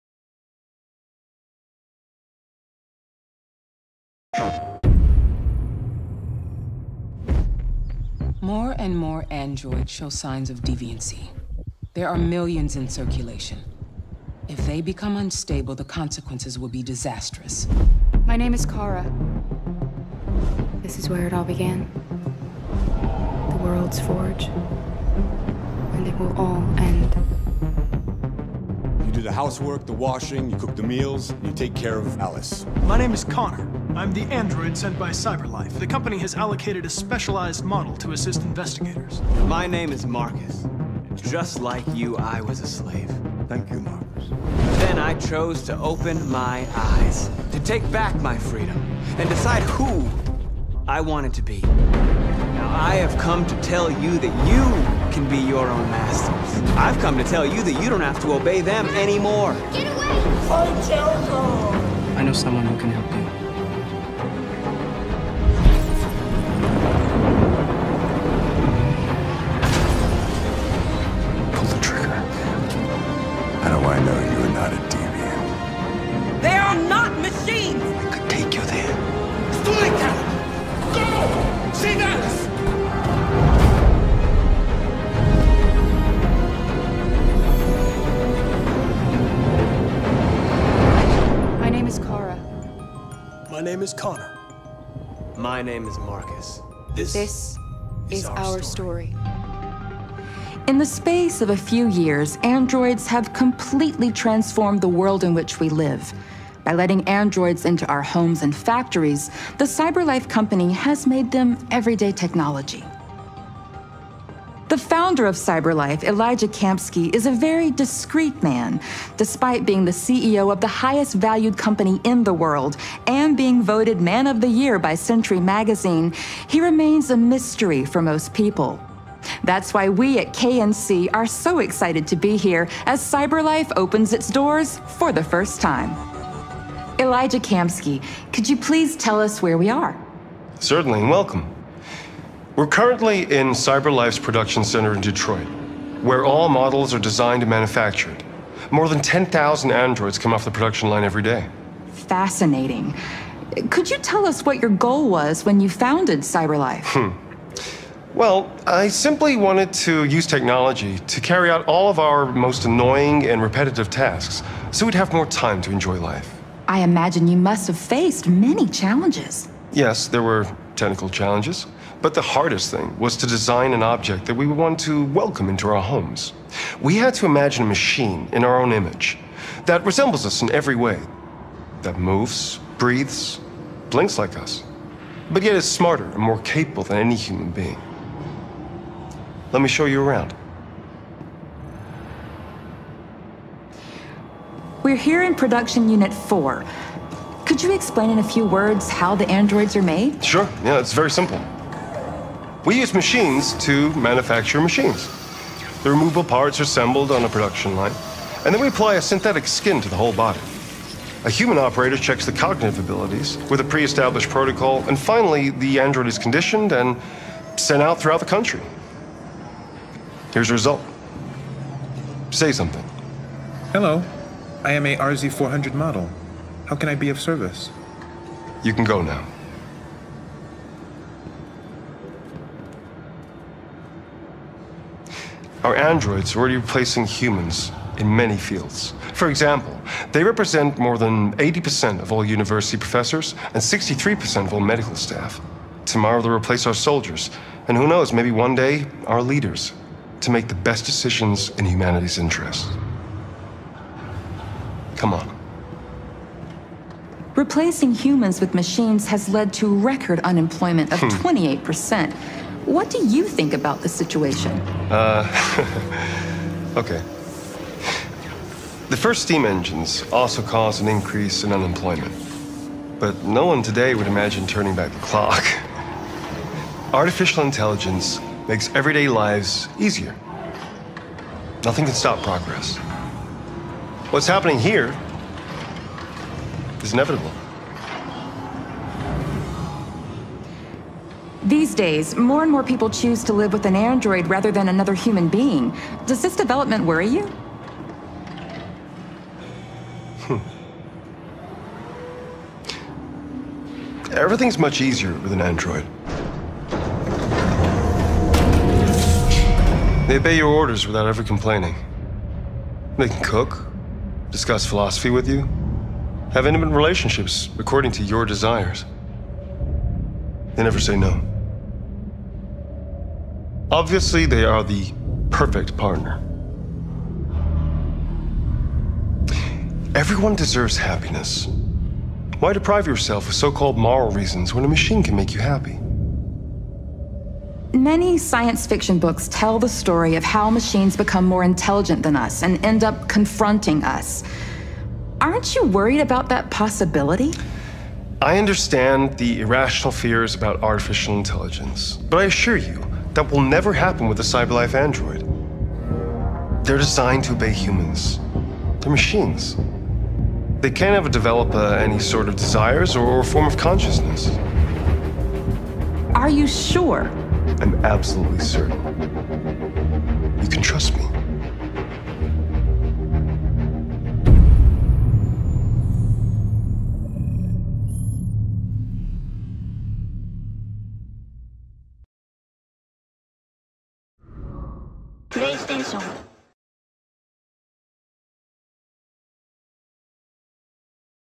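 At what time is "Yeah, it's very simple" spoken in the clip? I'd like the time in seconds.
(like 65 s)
200 s.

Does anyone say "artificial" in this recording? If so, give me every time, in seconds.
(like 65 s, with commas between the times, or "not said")
276 s, 350 s.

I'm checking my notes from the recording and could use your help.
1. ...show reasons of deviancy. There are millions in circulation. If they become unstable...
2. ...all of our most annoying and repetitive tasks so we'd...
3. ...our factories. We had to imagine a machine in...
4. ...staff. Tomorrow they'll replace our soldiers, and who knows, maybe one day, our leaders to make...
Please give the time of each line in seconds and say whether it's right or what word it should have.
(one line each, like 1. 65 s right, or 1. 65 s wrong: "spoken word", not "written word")
1. 9 s wrong: "signs", not "reasons"
2. 161 s right
3. 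175 s wrong: "homes", not "factories"
4. 244 s right.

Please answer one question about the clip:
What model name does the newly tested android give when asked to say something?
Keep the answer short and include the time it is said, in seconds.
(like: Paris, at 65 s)
RZ400, at 224 s.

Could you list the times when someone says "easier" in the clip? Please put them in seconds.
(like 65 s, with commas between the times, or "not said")
279 s, 304 s.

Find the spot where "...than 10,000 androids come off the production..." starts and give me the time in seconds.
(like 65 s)
148 s.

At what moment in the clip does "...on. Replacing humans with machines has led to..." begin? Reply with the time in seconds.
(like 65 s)
255 s.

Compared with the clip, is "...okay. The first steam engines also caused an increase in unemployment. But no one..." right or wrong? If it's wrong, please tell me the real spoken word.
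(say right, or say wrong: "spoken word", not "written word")
right.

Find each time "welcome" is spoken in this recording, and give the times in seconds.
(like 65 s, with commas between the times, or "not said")
141 s, 175 s.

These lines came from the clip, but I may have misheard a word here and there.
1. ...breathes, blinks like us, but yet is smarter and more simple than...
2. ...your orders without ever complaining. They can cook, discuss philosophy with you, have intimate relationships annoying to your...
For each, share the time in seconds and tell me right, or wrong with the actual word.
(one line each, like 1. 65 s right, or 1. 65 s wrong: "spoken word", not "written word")
1. 182 s wrong: "capable", not "simple"
2. 310 s wrong: "according", not "annoying".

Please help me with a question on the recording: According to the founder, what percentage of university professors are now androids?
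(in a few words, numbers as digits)
80%.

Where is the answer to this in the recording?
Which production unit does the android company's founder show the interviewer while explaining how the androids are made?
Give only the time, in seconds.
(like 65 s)
195 s.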